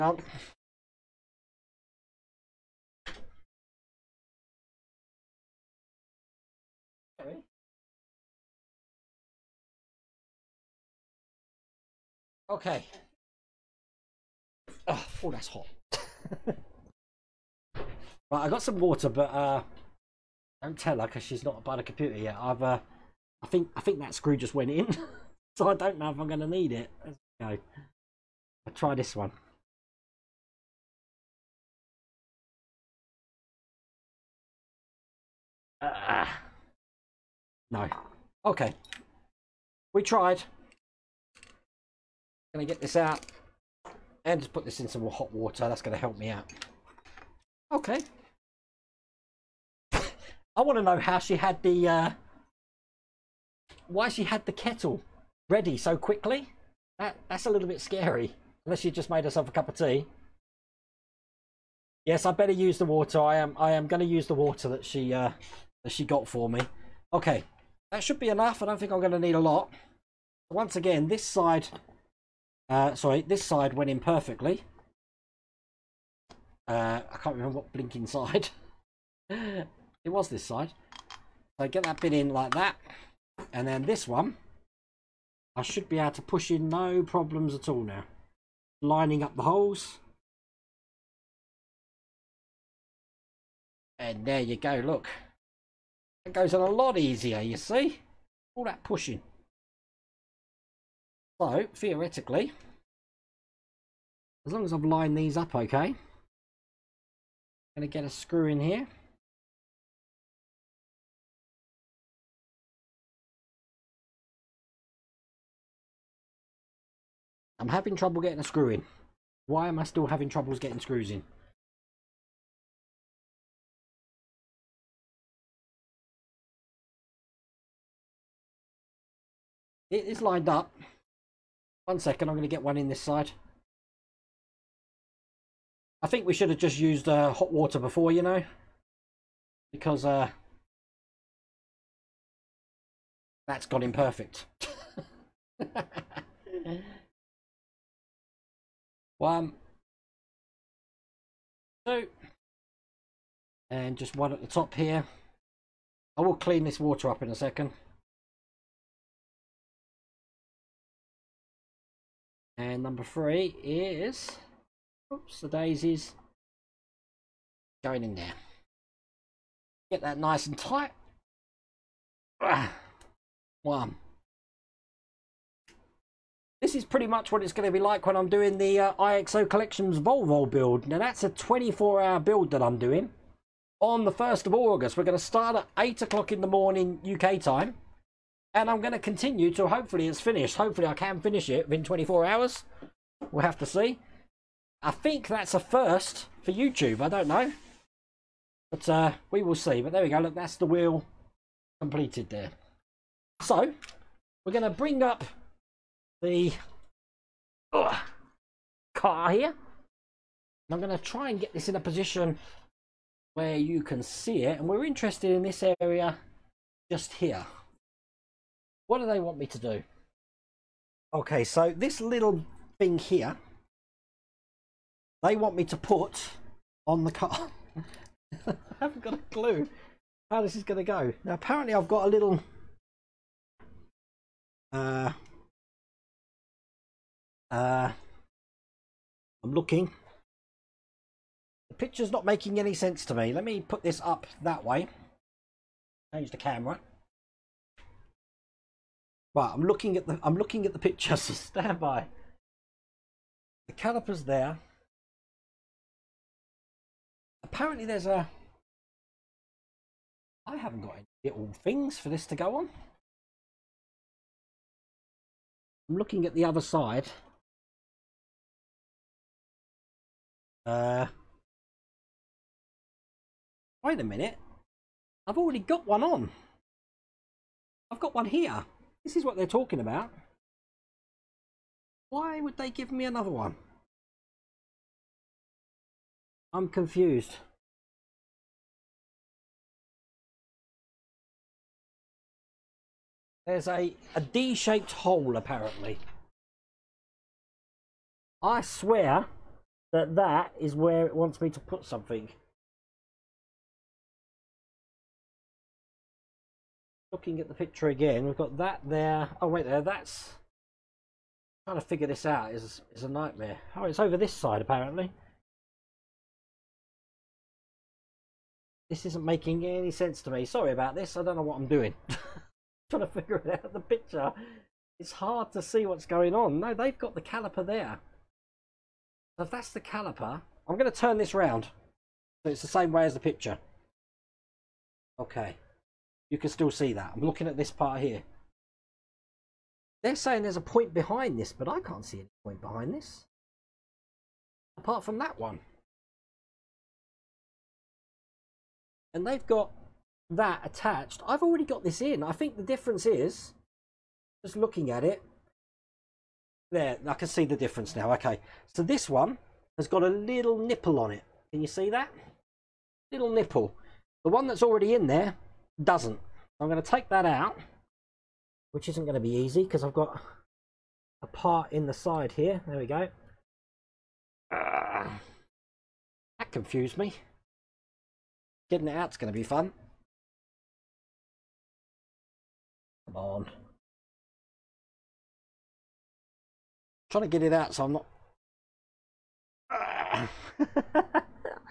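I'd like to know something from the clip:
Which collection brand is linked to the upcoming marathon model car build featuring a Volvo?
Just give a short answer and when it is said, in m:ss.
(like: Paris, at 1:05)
IXO Collections, at 2:58.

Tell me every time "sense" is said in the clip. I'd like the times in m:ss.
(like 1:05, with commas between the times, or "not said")
4:02, 5:19.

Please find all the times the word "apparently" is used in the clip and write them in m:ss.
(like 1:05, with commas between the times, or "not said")
3:51, 4:17, 4:55, 5:14.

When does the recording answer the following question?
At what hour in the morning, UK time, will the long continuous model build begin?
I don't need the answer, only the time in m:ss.
3:05.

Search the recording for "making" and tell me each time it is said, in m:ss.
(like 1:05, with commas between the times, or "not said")
4:02, 5:19.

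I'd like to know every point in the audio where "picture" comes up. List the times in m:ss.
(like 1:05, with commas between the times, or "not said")
4:01, 4:10, 5:07, 5:23, 5:33.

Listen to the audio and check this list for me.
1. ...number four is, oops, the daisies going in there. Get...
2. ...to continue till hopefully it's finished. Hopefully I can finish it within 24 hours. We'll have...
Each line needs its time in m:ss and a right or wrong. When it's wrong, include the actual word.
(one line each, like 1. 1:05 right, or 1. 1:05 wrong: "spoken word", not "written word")
1. 2:42 wrong: "three", not "four"
2. 3:08 right.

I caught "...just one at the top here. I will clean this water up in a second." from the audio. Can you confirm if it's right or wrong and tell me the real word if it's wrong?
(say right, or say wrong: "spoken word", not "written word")
right.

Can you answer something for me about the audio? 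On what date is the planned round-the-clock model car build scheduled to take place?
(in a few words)
1st of August.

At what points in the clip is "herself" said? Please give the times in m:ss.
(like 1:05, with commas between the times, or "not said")
0:59.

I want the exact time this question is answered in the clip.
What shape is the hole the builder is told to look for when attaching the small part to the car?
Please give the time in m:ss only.
4:54.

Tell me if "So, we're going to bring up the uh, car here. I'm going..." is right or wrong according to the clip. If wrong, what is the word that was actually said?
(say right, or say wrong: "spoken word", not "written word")
right.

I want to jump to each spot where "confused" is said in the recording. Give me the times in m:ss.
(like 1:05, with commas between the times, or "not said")
4:46, 6:16.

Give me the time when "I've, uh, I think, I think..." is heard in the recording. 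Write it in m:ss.
0:22.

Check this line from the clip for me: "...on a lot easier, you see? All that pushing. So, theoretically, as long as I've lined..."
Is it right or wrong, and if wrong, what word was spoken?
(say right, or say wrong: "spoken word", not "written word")
right.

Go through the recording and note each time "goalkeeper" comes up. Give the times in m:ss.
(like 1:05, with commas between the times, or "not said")
not said.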